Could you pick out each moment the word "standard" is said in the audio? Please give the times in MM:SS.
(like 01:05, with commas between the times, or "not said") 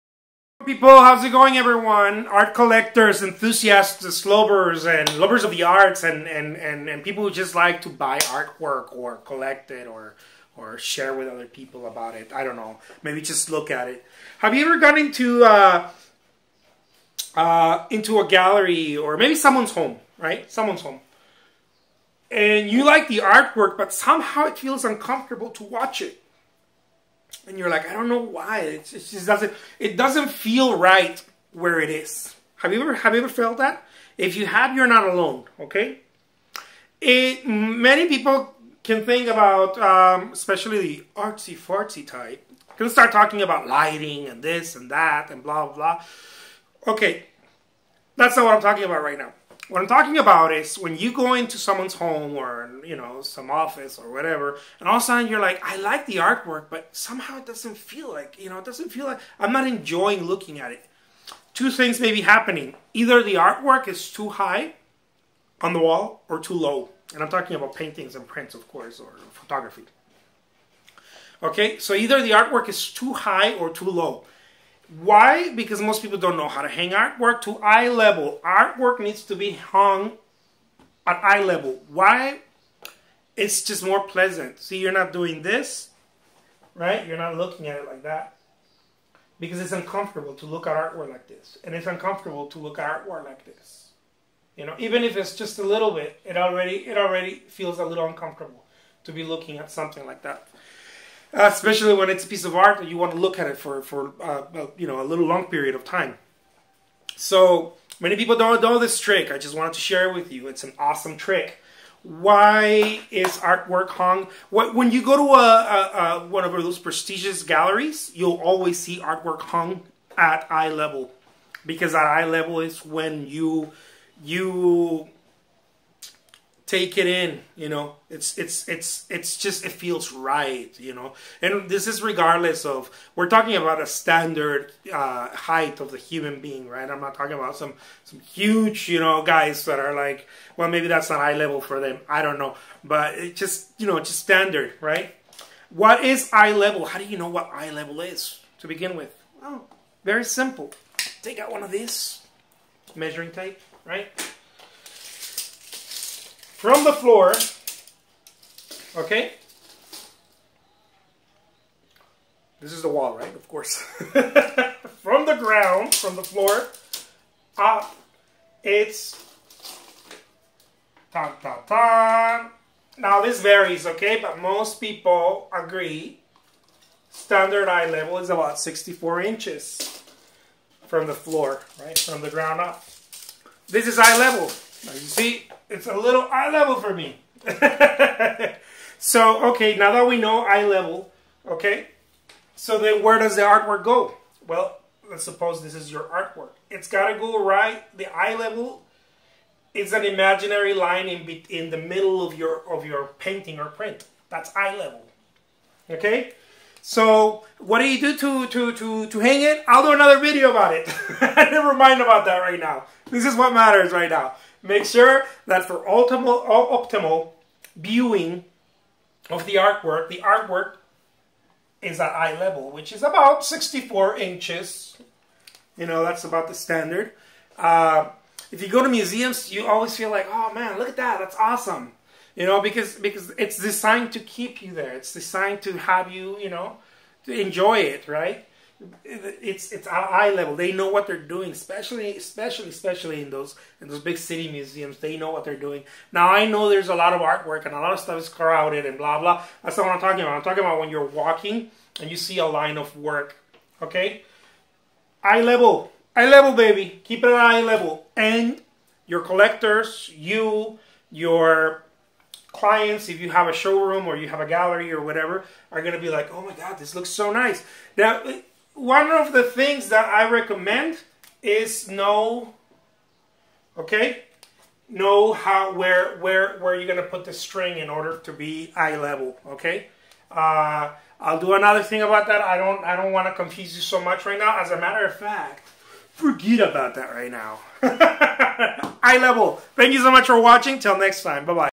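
02:13, 02:24, 02:57, 03:46.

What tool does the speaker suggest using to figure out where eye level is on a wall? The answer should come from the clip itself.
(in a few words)
measuring tape.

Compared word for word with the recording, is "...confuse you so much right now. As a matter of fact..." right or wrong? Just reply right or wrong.
right.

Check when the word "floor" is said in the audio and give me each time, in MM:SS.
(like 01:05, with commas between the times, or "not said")
02:36, 02:46, 03:01.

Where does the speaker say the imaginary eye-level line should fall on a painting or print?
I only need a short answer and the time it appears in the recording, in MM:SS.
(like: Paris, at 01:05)
in the middle, at 03:21.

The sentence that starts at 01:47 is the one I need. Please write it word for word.
So many people don't know this trick.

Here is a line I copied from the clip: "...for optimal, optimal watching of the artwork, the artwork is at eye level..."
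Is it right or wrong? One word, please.
wrong.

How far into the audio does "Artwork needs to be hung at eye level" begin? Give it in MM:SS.
01:18.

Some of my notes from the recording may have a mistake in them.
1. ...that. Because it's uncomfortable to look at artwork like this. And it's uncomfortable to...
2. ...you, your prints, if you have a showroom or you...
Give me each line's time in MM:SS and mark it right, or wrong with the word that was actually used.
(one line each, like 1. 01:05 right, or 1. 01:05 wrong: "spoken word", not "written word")
1. 01:28 right
2. 04:20 wrong: "clients", not "prints".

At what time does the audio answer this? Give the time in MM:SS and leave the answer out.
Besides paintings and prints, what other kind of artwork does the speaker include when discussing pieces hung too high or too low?
01:09.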